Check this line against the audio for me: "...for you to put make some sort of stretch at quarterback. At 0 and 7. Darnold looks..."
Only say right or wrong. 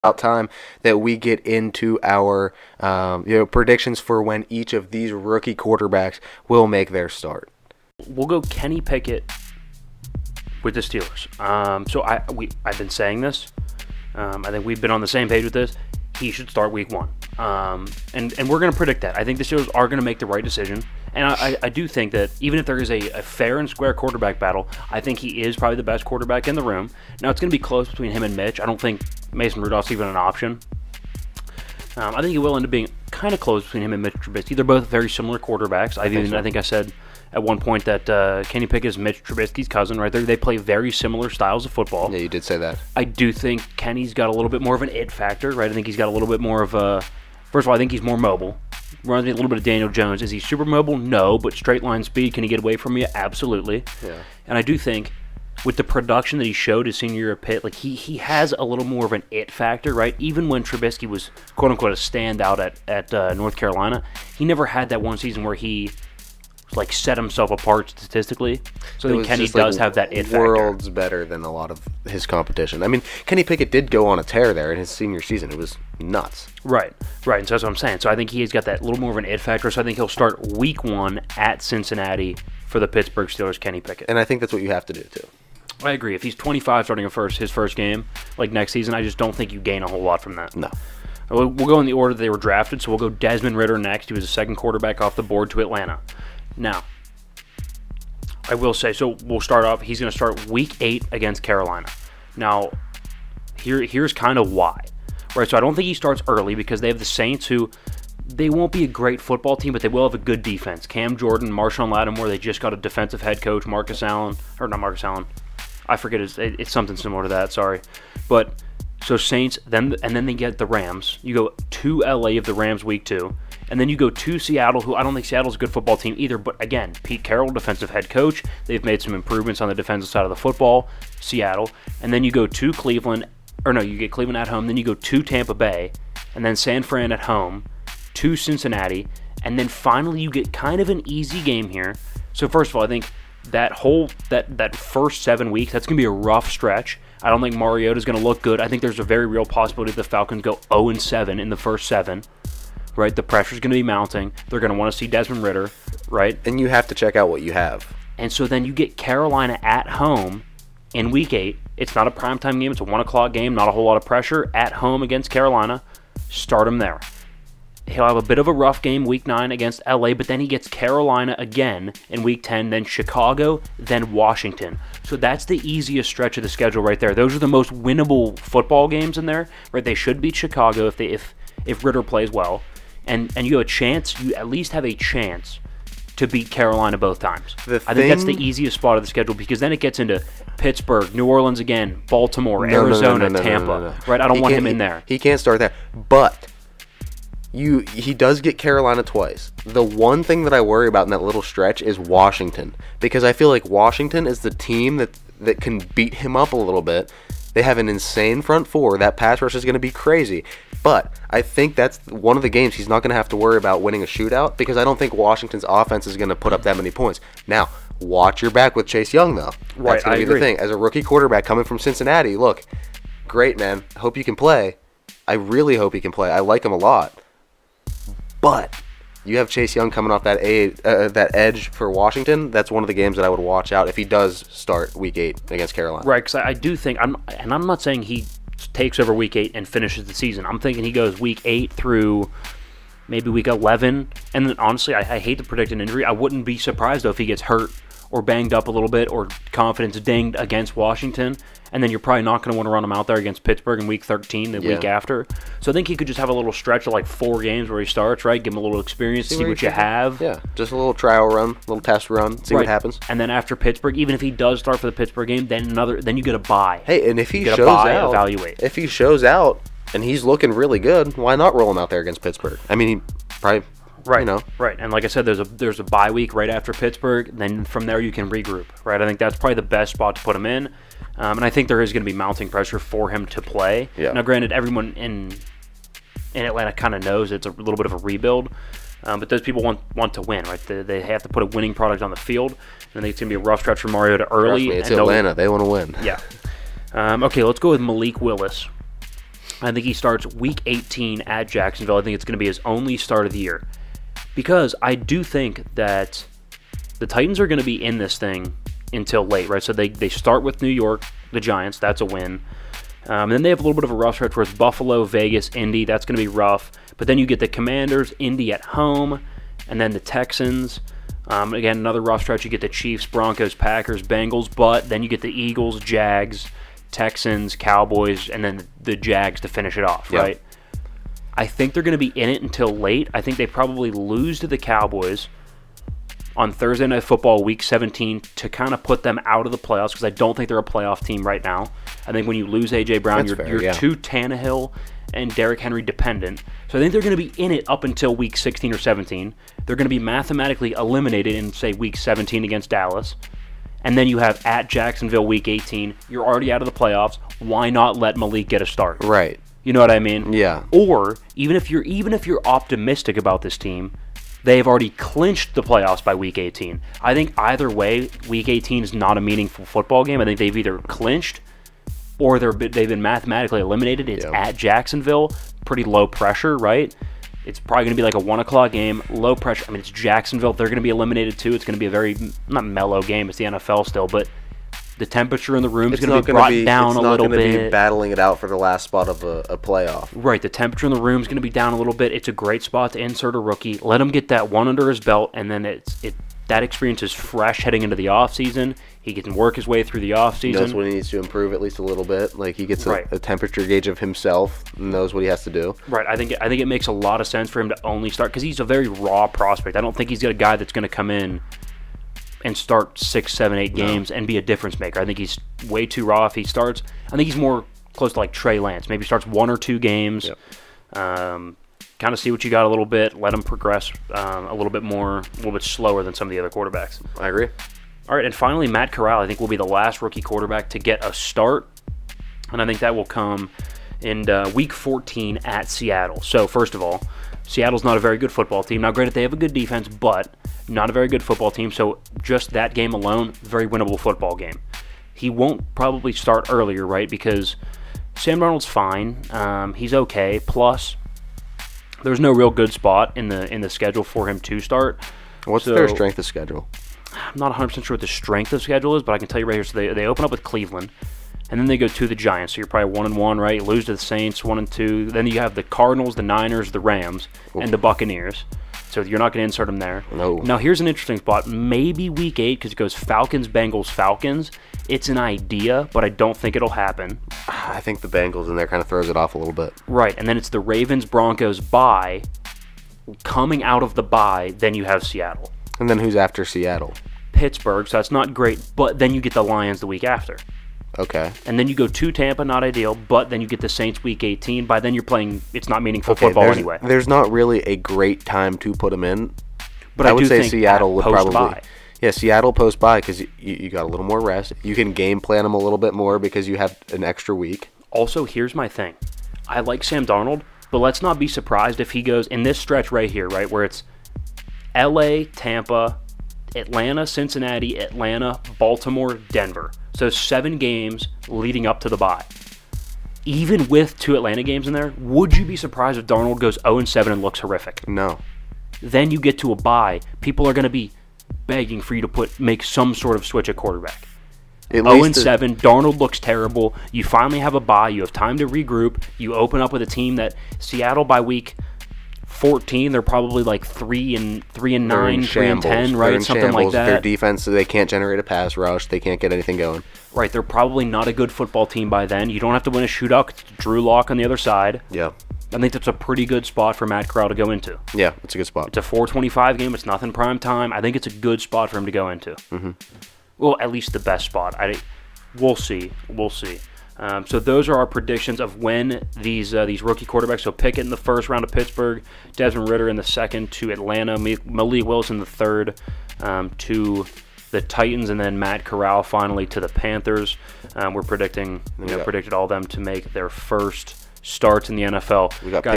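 wrong.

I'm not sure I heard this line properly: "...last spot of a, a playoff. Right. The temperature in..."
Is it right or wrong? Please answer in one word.
right.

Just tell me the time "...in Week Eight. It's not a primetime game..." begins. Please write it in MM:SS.
02:40.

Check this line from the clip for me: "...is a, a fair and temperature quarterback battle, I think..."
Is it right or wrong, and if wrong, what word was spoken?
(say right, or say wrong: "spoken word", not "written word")
wrong: "square", not "temperature".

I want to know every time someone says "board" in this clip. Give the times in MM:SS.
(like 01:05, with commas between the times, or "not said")
01:35.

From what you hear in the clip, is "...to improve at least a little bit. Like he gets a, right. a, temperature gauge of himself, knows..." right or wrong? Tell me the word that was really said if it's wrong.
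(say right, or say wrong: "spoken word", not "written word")
right.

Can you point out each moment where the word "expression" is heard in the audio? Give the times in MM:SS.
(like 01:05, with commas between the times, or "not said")
not said.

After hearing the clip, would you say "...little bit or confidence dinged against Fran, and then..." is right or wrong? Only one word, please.
wrong.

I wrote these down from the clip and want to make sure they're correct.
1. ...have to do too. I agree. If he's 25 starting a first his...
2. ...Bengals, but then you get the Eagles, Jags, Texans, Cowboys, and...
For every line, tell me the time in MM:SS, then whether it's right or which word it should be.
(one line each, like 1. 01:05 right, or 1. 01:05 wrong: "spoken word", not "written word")
1. 01:24 right
2. 05:24 right.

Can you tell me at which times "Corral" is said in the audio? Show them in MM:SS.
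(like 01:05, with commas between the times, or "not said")
07:08, 09:17, 09:38.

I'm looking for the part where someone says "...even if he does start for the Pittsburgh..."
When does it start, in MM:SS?
04:23.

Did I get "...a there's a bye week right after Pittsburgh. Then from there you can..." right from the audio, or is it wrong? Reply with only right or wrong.
right.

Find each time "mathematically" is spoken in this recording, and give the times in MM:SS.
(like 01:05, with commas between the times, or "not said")
05:49, 06:13.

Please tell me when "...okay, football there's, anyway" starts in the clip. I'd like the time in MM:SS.
08:16.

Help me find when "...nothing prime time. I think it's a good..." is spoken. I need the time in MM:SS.
09:19.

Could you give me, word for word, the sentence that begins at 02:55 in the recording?
So that's the easiest stretch of the schedule right there.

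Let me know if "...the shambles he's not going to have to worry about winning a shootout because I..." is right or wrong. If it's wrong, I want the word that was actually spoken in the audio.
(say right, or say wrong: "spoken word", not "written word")
wrong: "games", not "shambles".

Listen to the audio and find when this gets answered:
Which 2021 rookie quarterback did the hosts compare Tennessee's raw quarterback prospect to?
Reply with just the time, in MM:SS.
06:58.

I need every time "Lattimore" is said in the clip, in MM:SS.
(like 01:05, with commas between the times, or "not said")
01:51.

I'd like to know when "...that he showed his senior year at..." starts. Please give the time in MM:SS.
00:56.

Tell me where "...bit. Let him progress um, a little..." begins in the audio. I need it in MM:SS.
07:02.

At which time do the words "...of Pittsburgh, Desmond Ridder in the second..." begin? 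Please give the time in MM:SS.
09:31.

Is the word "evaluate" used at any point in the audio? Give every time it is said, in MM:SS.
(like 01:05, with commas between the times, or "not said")
04:28.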